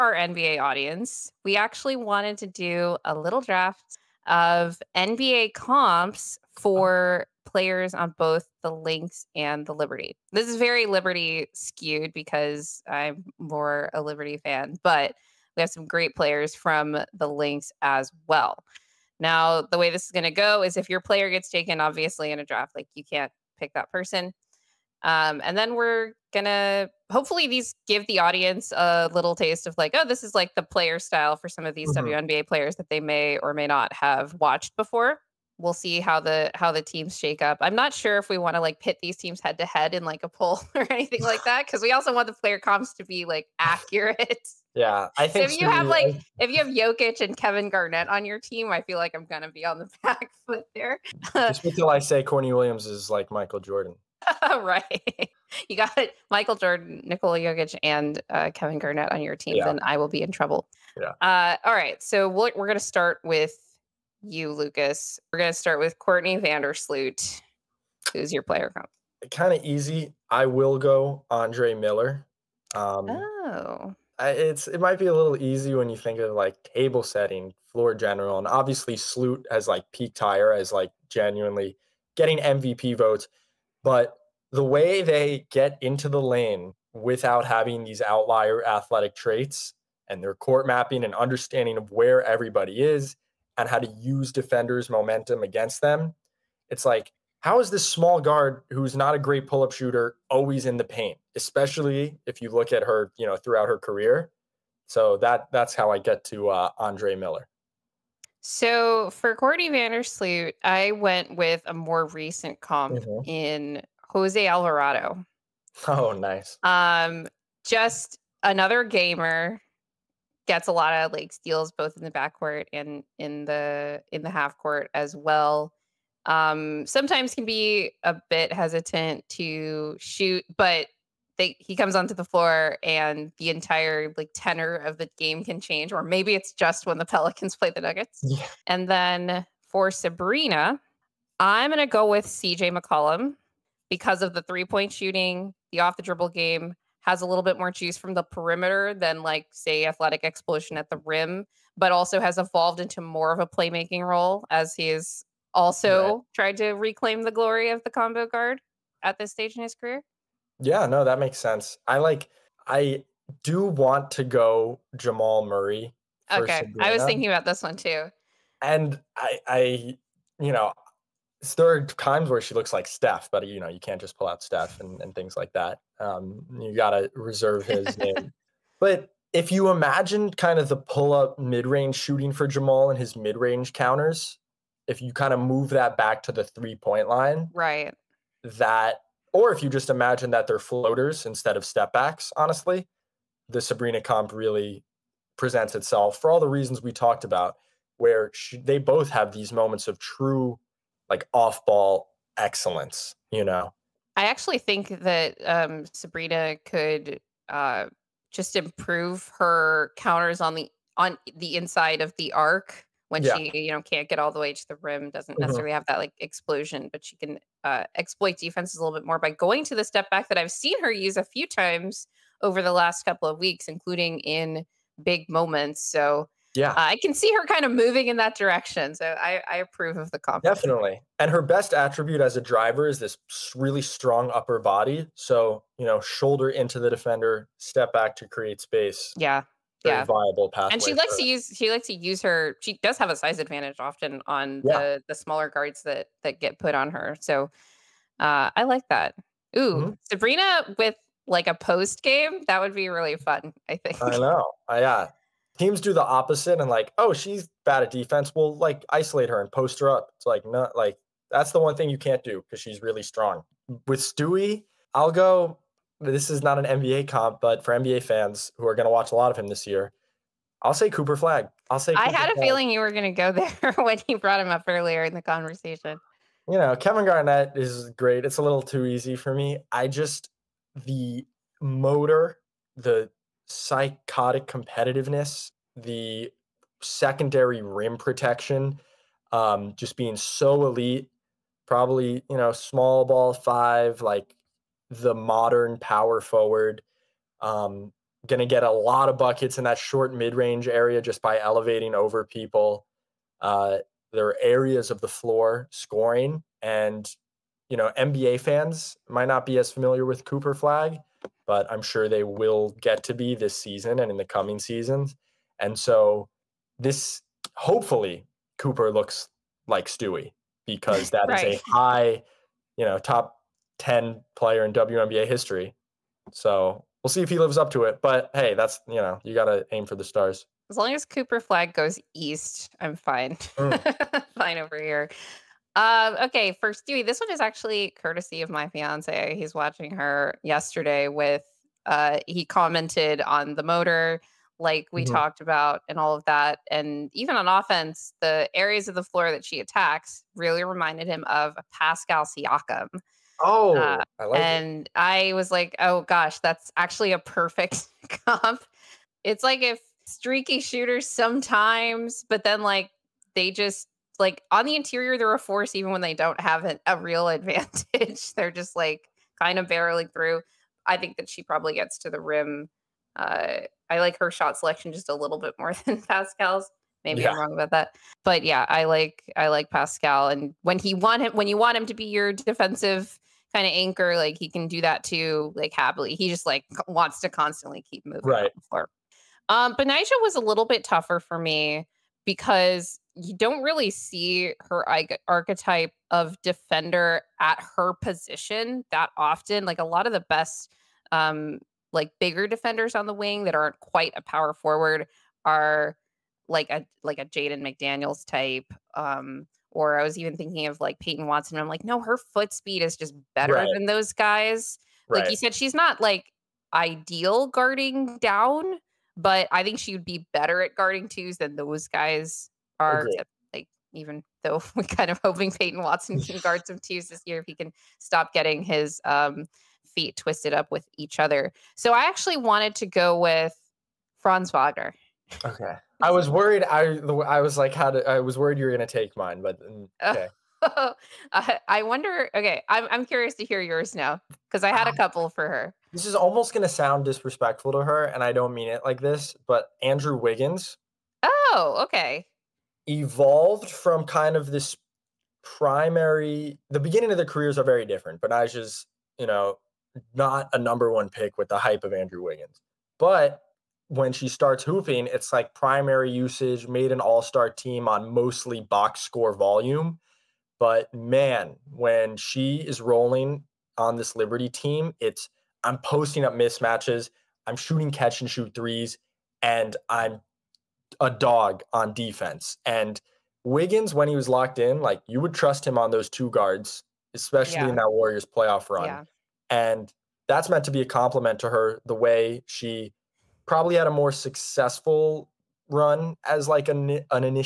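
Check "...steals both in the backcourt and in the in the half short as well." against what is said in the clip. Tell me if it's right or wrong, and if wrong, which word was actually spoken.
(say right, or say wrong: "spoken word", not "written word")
wrong: "court", not "short".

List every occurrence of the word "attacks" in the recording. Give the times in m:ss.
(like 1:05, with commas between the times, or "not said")
5:49.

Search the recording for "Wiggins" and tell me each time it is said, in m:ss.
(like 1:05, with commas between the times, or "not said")
7:30, 7:42, 8:03.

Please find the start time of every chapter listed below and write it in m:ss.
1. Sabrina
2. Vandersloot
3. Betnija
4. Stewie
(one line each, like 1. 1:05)
1. 2:18
2. 1:04
3. 6:28
4. 4:22.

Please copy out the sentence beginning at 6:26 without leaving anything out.
He just like wants to constantly keep moving.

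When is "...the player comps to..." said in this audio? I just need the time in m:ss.
0:42.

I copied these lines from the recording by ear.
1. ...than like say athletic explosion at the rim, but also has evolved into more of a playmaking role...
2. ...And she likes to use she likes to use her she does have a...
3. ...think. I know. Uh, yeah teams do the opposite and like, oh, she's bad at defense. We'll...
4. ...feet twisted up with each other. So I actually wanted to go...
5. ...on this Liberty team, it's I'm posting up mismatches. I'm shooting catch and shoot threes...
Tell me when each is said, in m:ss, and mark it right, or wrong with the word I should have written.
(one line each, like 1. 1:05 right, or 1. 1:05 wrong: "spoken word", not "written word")
1. 2:28 right
2. 4:00 right
3. 4:13 right
4. 7:09 right
5. 7:53 right.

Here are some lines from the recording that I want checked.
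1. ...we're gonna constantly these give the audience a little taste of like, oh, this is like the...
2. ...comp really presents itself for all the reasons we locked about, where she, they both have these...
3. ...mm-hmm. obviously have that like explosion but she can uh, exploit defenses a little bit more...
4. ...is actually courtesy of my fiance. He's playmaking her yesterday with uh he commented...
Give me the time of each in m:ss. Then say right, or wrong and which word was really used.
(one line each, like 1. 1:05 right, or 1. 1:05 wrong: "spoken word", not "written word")
1. 0:25 wrong: "hopefully", not "constantly"
2. 3:13 wrong: "talked", not "locked"
3. 3:35 wrong: "necessarily", not "obviously"
4. 5:37 wrong: "watching", not "playmaking".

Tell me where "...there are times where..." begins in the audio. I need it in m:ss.
2:51.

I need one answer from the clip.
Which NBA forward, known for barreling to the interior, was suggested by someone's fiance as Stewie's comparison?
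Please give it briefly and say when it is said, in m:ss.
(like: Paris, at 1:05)
Pascal Siakam, at 5:51.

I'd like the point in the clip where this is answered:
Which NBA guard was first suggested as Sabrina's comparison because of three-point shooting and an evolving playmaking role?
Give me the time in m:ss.
2:22.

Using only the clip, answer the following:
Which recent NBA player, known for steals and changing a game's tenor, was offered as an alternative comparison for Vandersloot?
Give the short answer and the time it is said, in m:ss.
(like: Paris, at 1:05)
Jose Alvarado, at 1:54.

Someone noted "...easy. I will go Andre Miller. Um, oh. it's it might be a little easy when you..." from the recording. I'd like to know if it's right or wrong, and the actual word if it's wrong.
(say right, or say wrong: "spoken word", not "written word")
right.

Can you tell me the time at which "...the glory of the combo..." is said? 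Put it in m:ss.
2:37.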